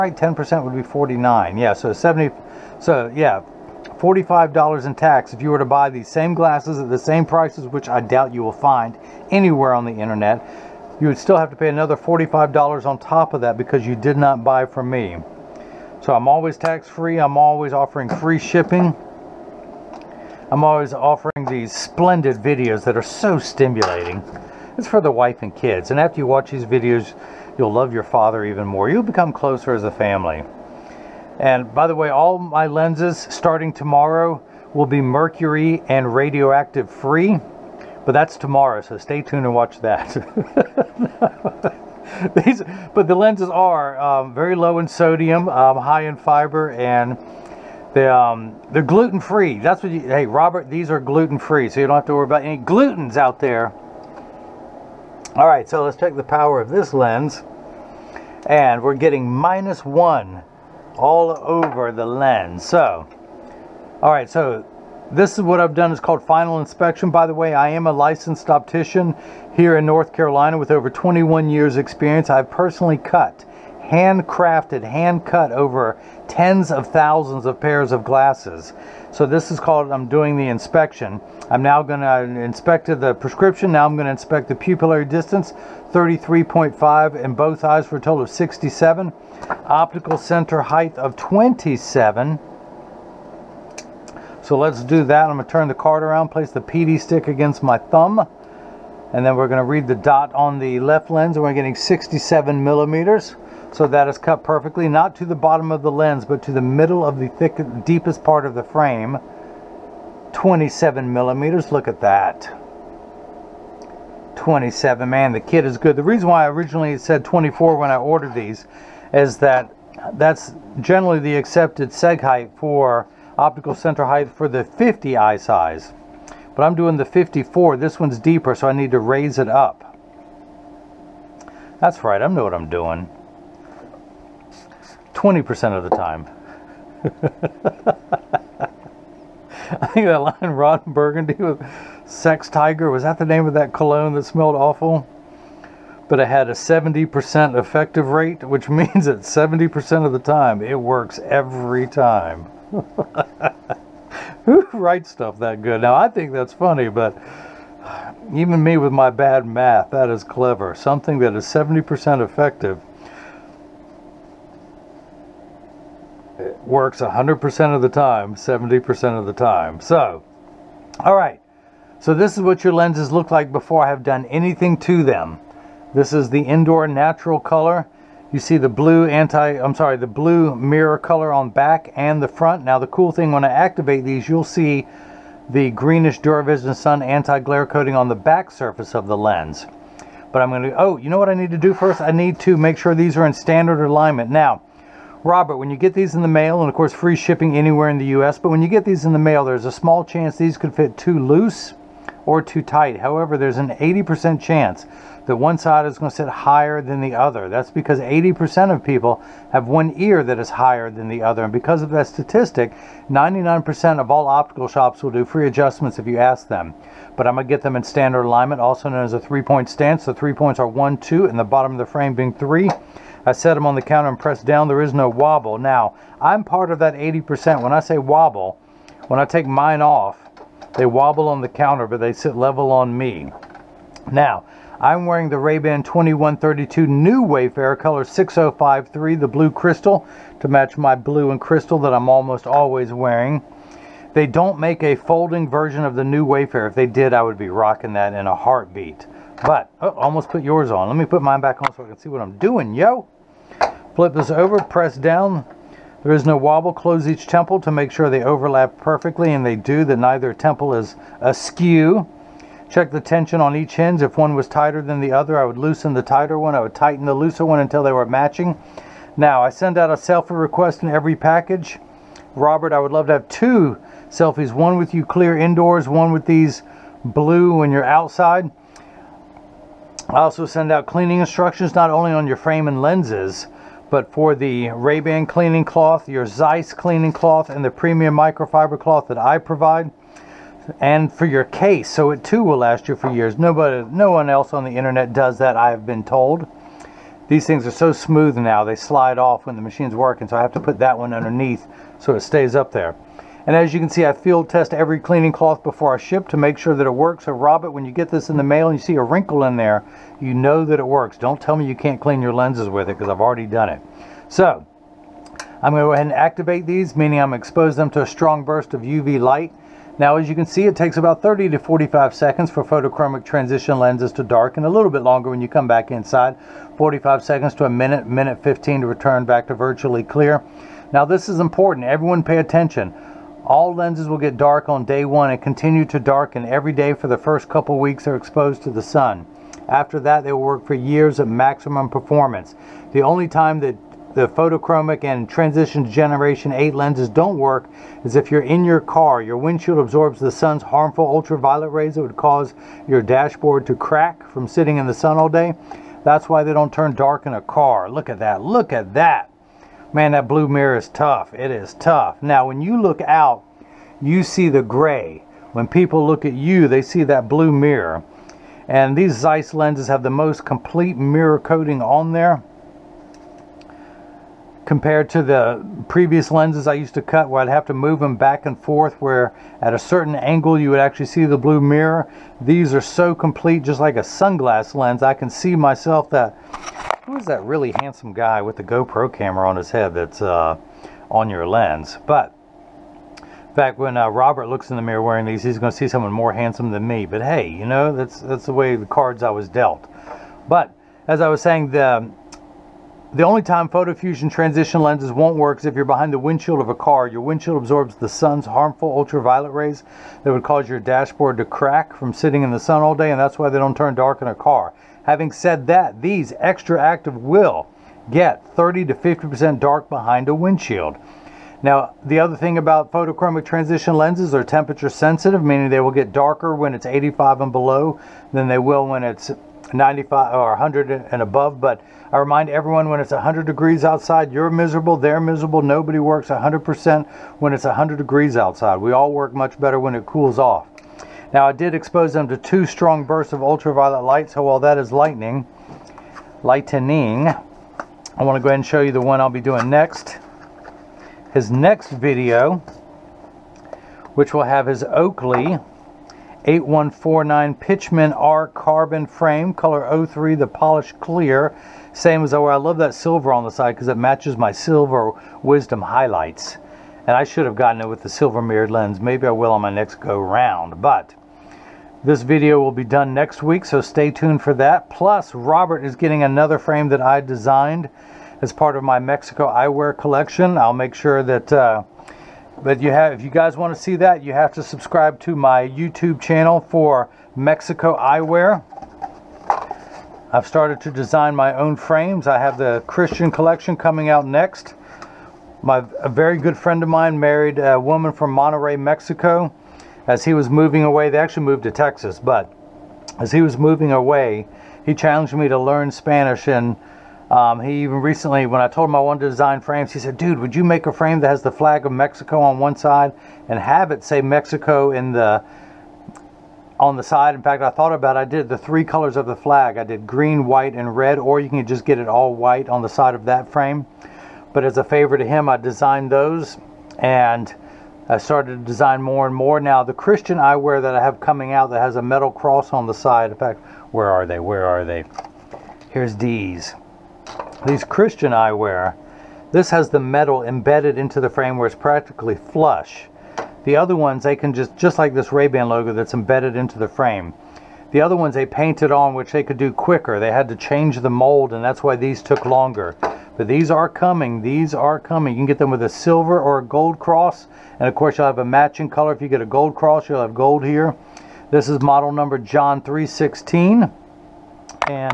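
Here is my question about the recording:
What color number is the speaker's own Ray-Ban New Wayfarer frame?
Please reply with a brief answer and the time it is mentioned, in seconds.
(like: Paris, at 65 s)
6053, at 238 s.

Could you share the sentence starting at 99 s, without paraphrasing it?
And then we're going to read the dot on the left lens.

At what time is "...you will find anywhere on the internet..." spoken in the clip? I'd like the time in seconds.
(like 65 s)
8 s.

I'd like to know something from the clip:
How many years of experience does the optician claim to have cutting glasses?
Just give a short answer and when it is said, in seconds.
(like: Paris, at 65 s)
21 years, at 70 s.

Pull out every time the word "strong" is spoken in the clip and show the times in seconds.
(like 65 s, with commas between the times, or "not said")
318 s, 442 s.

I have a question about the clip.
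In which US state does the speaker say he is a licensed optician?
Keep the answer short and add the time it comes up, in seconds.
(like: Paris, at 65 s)
North Carolina, at 69 s.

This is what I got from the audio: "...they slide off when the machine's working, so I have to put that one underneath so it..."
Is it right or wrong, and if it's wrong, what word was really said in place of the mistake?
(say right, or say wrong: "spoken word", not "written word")
right.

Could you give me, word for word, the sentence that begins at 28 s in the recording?
You'll become closer as a family.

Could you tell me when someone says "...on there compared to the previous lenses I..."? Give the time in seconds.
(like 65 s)
371 s.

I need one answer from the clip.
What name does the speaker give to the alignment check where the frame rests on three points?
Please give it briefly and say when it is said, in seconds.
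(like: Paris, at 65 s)
three point stance, at 219 s.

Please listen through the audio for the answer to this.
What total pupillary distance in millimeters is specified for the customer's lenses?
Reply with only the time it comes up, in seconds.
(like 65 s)
88 s.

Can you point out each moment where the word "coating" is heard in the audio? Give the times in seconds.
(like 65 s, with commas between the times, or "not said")
187 s, 371 s.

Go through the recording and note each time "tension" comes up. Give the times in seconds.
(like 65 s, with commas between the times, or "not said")
263 s.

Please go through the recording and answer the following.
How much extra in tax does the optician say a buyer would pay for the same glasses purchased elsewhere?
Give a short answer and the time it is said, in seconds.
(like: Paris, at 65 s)
$45, at 3 s.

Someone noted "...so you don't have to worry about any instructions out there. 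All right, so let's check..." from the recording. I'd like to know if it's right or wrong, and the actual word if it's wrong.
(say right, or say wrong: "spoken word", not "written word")
wrong: "glutens", not "instructions".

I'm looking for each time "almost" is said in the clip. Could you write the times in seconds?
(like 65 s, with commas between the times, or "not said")
242 s, 249 s.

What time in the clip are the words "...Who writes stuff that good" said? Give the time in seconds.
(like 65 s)
154 s.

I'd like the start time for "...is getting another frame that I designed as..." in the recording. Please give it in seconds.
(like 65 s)
475 s.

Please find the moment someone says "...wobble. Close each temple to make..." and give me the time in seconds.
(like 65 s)
256 s.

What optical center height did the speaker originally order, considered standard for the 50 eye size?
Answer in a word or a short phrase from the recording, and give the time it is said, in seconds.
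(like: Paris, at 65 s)
24, at 117 s.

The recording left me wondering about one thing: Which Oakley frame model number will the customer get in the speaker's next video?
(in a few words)
8149.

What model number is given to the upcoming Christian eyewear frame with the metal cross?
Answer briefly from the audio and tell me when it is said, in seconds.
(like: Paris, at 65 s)
John 316, at 562 s.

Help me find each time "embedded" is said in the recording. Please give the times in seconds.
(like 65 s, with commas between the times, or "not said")
540 s, 546 s.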